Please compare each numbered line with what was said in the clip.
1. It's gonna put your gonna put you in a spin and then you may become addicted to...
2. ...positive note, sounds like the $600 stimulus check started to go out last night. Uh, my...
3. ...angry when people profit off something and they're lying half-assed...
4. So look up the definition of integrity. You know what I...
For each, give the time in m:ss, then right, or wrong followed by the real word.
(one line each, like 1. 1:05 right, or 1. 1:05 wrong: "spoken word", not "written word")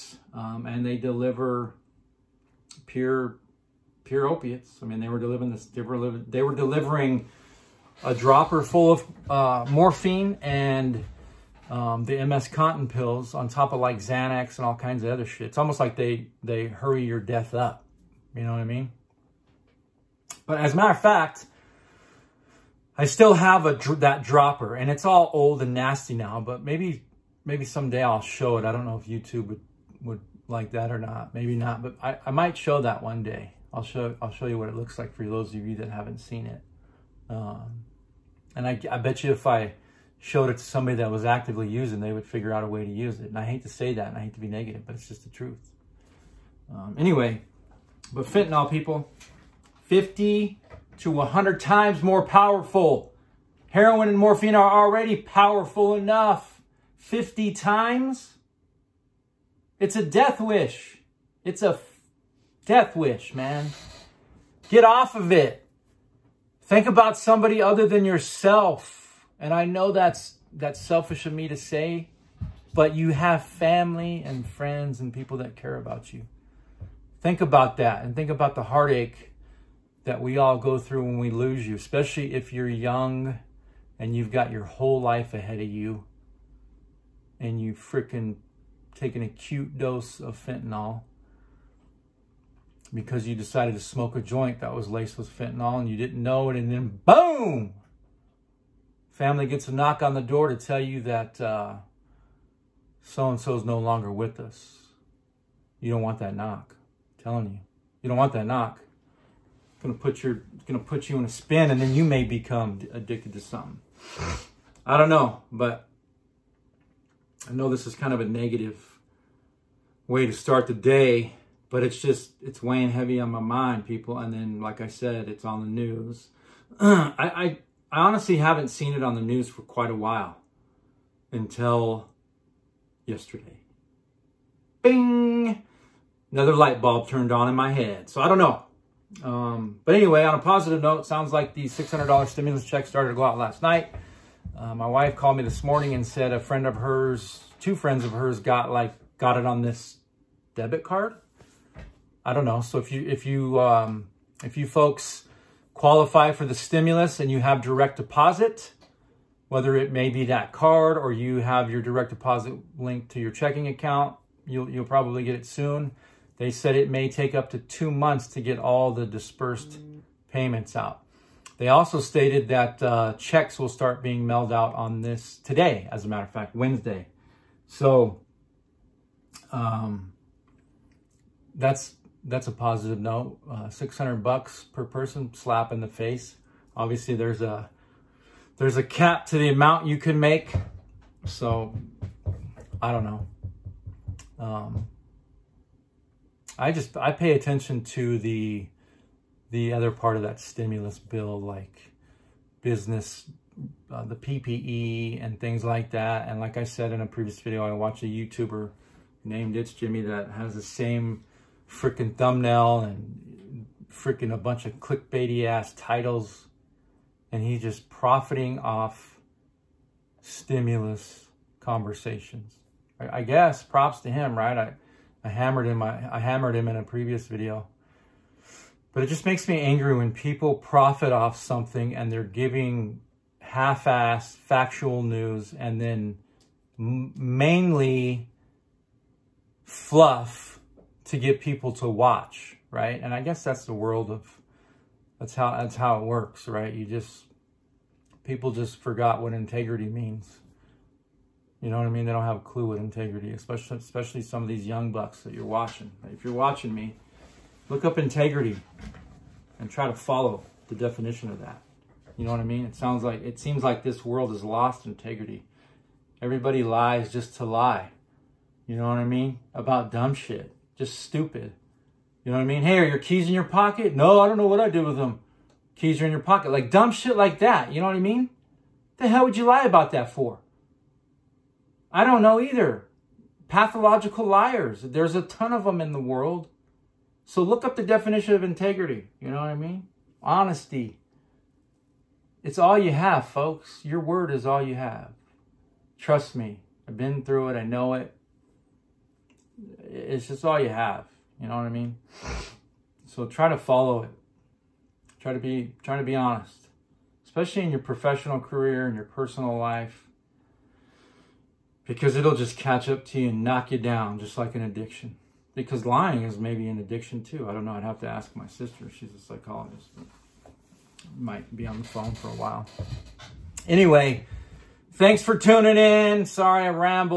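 1. 1:49 right
2. 2:20 right
3. 3:49 wrong: "giving", not "lying"
4. 4:47 right.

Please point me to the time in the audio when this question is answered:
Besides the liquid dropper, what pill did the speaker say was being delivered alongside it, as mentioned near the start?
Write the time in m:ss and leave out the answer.
0:12.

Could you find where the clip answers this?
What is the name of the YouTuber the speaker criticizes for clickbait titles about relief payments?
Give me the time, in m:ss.
3:29.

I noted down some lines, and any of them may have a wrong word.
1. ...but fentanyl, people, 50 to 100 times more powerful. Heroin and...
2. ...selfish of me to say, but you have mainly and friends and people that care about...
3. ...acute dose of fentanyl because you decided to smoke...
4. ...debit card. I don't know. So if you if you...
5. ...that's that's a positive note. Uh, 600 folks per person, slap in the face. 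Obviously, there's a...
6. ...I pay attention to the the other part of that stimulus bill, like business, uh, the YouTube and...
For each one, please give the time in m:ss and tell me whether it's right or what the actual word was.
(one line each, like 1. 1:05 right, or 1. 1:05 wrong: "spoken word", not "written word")
1. 0:48 right
2. 1:10 wrong: "family", not "mainly"
3. 1:29 right
4. 2:30 right
5. 3:01 wrong: "bucks", not "folks"
6. 3:16 wrong: "PPP", not "YouTube".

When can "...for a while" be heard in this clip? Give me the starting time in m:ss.
5:22.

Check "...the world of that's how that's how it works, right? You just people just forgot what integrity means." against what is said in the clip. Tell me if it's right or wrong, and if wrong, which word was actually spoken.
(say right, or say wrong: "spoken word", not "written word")
right.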